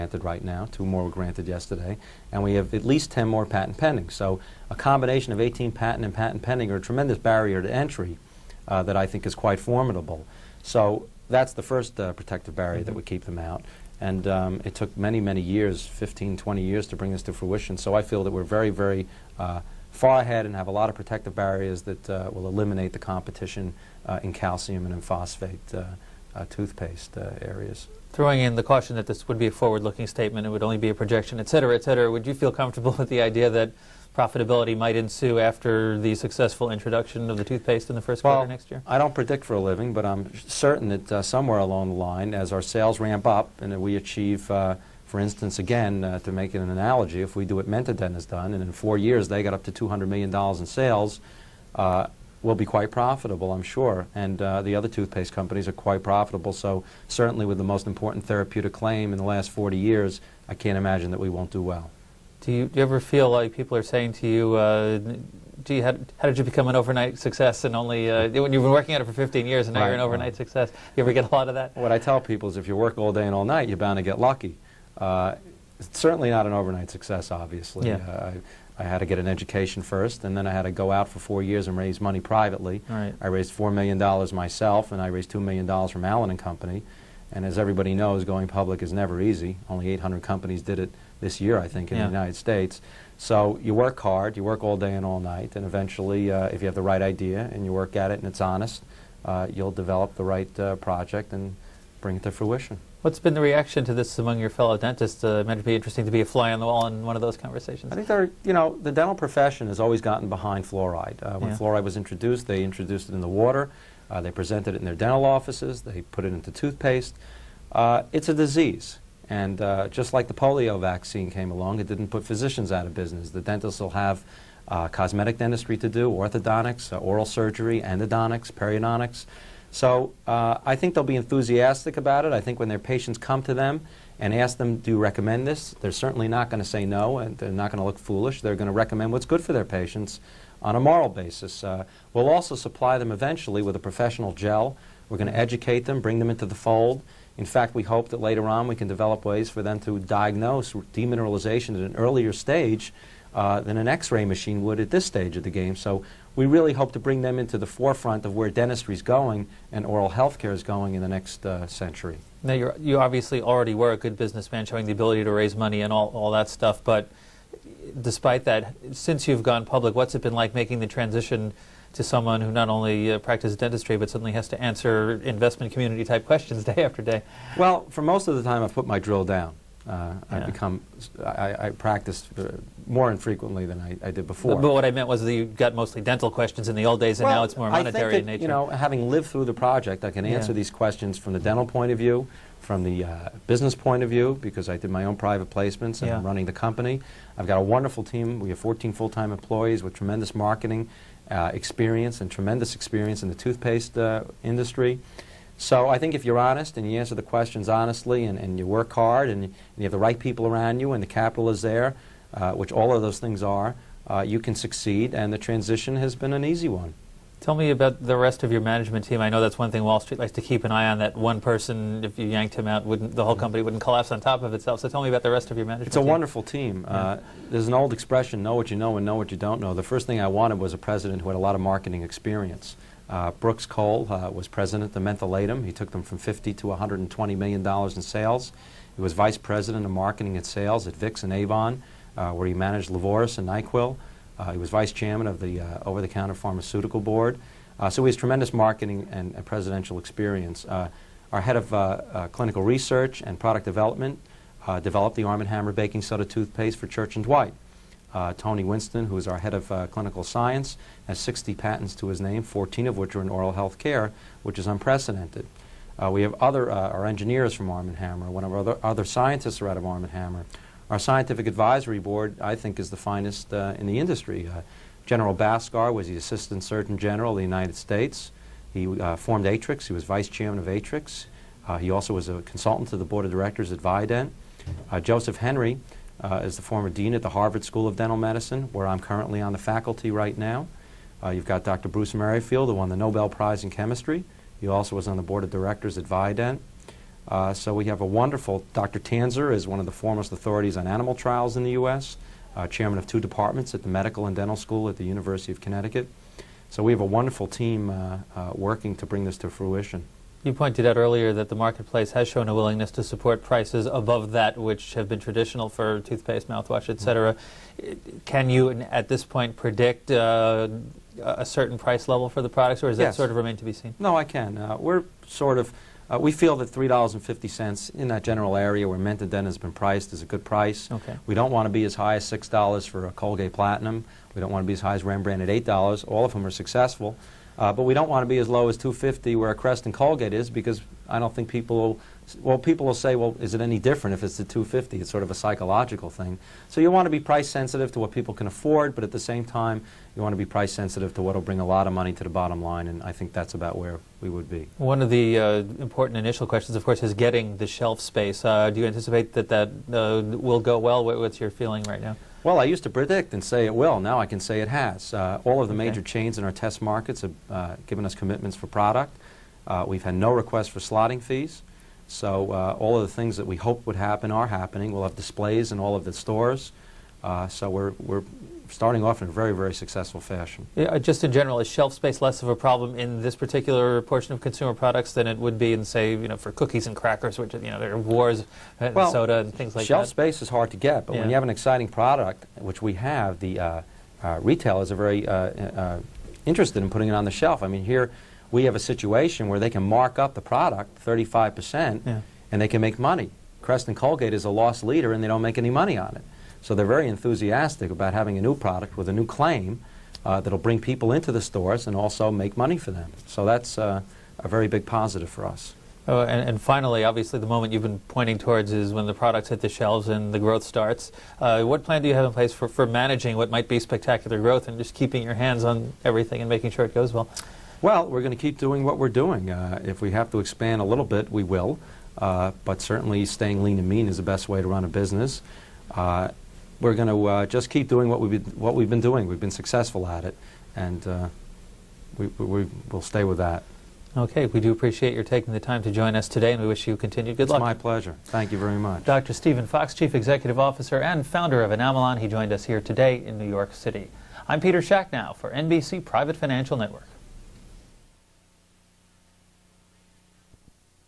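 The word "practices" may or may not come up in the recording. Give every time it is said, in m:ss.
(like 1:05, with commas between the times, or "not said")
2:53, 3:01.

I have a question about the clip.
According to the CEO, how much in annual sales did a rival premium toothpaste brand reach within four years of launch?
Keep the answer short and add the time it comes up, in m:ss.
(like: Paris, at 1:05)
$200 million, at 0:49.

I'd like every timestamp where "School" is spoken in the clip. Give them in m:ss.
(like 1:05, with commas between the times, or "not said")
4:47, 5:04.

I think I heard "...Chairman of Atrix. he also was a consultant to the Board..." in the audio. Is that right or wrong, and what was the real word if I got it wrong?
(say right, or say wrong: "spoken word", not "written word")
right.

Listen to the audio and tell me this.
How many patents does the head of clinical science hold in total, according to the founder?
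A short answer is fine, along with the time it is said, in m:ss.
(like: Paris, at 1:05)
60, at 4:21.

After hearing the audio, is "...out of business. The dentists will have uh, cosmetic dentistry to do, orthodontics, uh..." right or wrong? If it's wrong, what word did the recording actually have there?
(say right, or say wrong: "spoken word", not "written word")
right.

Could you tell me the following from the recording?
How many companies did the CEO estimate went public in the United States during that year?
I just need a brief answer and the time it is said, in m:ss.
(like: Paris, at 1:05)
800, at 1:29.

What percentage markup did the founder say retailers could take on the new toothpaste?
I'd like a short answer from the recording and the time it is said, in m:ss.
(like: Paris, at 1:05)
35%, at 6:41.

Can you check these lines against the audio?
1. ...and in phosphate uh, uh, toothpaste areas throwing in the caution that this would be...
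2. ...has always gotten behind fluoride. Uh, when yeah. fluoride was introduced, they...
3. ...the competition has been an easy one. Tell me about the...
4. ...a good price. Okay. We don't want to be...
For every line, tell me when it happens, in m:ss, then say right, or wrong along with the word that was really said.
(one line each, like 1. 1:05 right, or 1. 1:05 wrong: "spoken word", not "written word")
1. 0:24 right
2. 1:49 right
3. 3:35 wrong: "transition", not "competition"
4. 5:30 right.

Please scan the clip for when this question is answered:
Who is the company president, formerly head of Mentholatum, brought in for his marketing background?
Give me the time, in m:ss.
3:53.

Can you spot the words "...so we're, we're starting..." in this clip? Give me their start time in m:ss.
6:17.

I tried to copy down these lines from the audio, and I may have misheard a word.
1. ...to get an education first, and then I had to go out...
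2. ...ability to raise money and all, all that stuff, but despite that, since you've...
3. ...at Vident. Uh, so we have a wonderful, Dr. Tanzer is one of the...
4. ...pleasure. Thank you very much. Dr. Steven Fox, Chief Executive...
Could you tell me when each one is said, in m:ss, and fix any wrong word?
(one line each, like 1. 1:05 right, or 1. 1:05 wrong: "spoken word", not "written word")
1. 1:18 right
2. 2:44 right
3. 4:55 right
4. 7:27 right.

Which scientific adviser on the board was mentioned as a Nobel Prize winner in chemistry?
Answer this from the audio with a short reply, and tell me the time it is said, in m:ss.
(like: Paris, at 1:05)
Bruce Merrifield, at 4:51.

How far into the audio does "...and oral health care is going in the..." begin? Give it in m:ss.
2:39.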